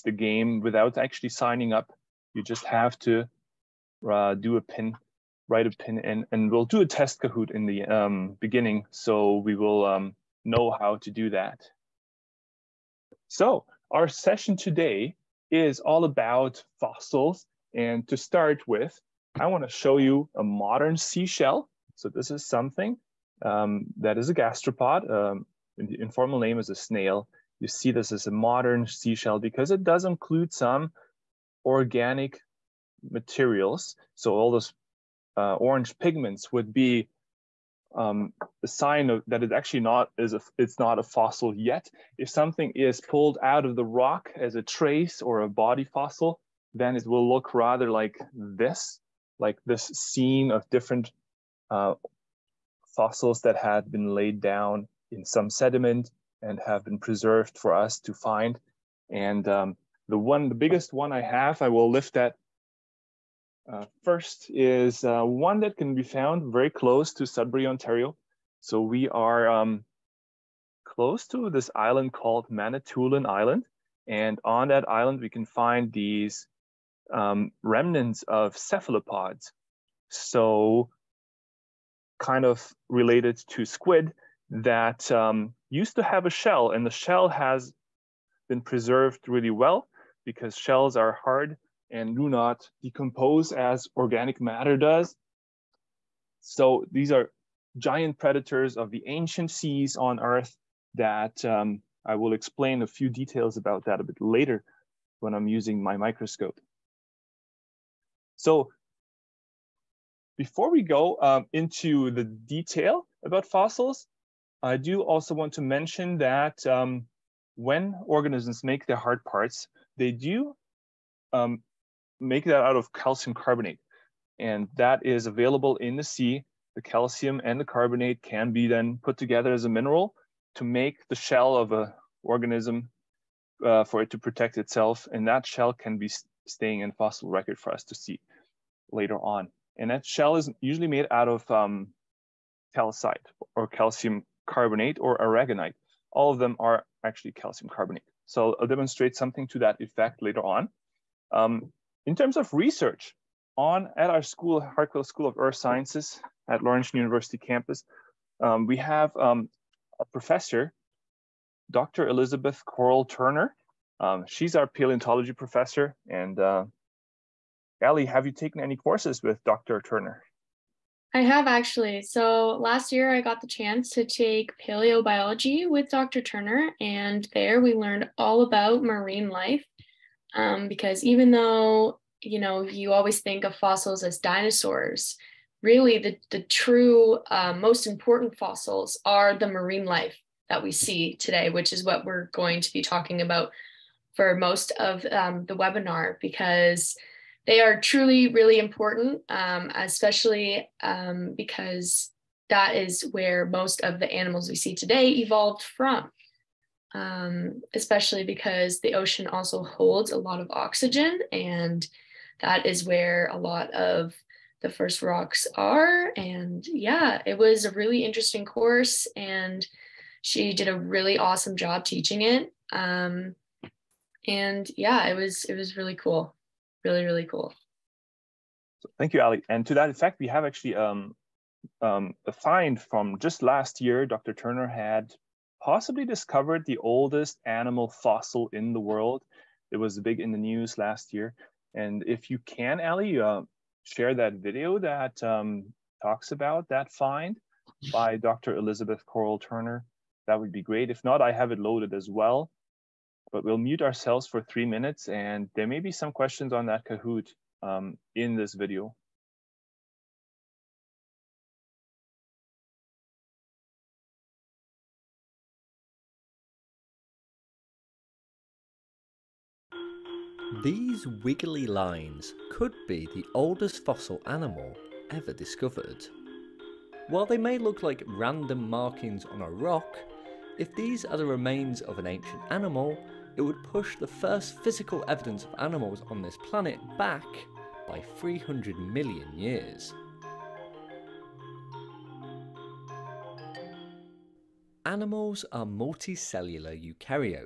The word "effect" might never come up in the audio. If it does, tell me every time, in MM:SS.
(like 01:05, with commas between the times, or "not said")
02:29, 03:49.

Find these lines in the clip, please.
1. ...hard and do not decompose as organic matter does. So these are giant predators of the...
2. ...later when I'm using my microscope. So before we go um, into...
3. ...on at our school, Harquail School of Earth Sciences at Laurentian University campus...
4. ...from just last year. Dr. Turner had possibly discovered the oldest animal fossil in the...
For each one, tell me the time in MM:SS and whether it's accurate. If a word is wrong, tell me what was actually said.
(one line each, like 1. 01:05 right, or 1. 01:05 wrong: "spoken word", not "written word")
1. 01:31 right
2. 01:44 right
3. 02:33 right
4. 03:52 right.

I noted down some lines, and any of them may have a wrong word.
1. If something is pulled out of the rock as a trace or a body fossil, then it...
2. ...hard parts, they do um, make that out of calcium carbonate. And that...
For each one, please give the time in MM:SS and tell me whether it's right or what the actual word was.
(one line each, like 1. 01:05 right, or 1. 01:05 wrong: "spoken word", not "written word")
1. 00:42 right
2. 01:58 right.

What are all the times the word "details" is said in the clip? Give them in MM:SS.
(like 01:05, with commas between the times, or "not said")
01:43, 01:52.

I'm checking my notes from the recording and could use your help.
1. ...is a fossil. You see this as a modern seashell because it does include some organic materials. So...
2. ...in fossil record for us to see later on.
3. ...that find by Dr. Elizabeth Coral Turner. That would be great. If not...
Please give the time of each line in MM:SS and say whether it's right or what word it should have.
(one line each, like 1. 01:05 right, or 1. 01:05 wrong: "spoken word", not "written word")
1. 00:26 wrong: "snail", not "fossil"
2. 02:16 right
3. 04:06 right.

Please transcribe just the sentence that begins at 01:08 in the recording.
So we are um, close to this island called Manitoulin Island.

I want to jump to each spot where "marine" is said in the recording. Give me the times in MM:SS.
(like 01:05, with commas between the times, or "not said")
02:58, 03:09.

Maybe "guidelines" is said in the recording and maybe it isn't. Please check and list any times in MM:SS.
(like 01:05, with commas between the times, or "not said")
not said.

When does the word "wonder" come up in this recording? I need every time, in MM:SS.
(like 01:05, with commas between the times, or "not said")
not said.